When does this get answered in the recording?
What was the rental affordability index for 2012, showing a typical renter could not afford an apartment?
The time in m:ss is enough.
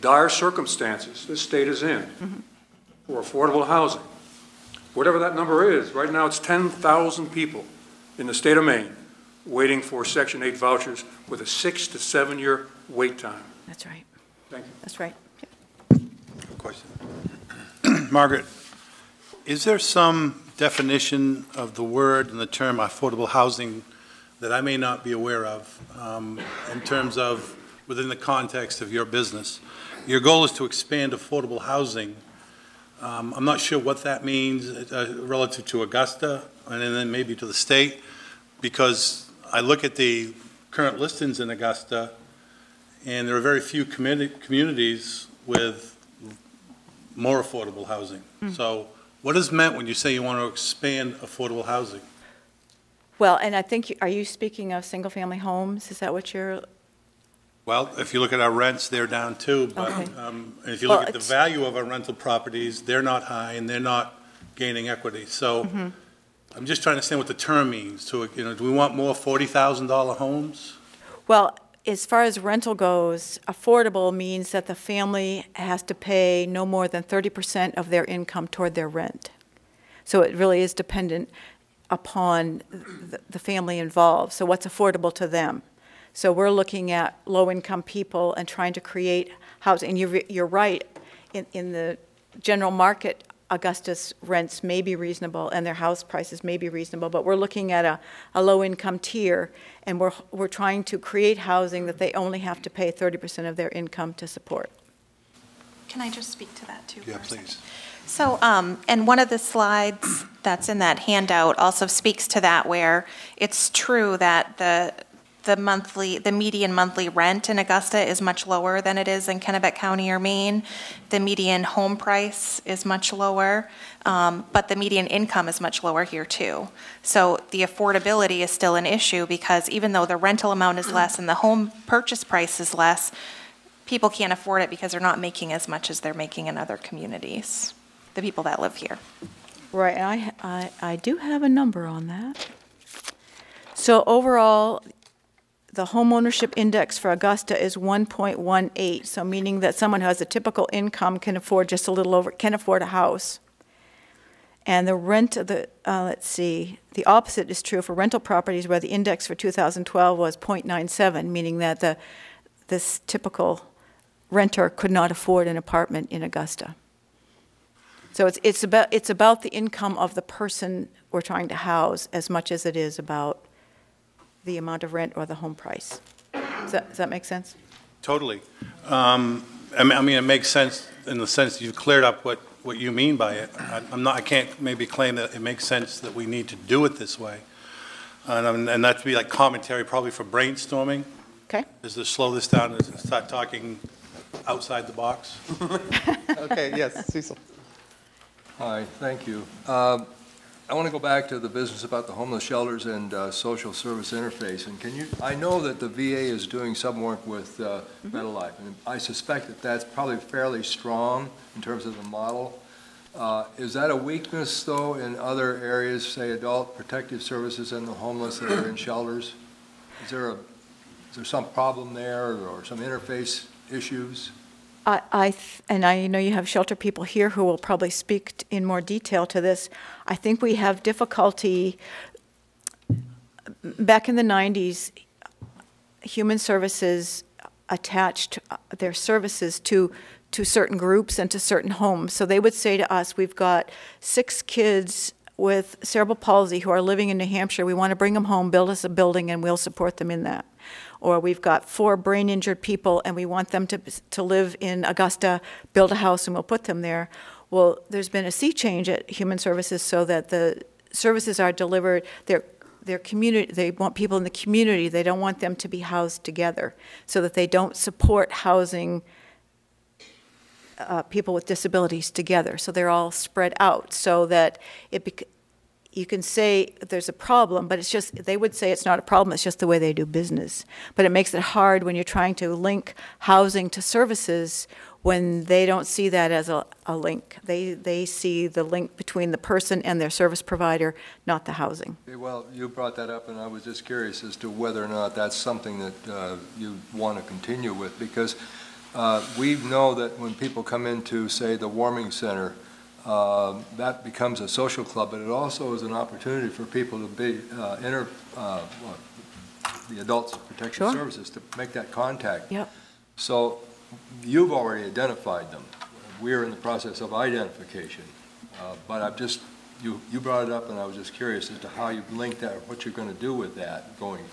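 2:40.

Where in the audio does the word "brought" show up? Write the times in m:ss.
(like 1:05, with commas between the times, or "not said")
4:52, 5:20.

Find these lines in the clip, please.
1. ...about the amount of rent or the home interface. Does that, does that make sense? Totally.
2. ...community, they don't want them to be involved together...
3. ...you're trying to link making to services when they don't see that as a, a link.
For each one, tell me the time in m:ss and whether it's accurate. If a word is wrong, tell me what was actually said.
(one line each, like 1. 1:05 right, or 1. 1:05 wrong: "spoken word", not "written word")
1. 2:52 wrong: "price", not "interface"
2. 4:24 wrong: "housed", not "involved"
3. 4:41 wrong: "housing", not "making".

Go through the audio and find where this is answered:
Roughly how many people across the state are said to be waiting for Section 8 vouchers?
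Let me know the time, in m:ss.
0:06.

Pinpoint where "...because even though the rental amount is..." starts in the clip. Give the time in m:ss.
2:09.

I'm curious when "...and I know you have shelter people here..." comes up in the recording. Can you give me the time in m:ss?
3:45.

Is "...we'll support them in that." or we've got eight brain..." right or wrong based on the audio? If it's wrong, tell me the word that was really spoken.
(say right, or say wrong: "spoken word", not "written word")
wrong: "four", not "eight".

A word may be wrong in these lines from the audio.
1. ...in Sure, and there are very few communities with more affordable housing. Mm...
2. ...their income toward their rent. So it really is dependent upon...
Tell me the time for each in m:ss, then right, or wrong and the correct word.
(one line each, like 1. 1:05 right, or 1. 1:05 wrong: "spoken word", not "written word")
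1. 0:41 wrong: "Augusta", not "Sure"
2. 1:17 right.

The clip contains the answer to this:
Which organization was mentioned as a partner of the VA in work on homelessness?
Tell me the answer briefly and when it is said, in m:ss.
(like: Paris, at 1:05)
Bread of Life, at 3:28.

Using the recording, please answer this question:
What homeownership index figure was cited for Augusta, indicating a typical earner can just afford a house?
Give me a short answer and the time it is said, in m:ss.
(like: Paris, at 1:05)
1.18, at 2:27.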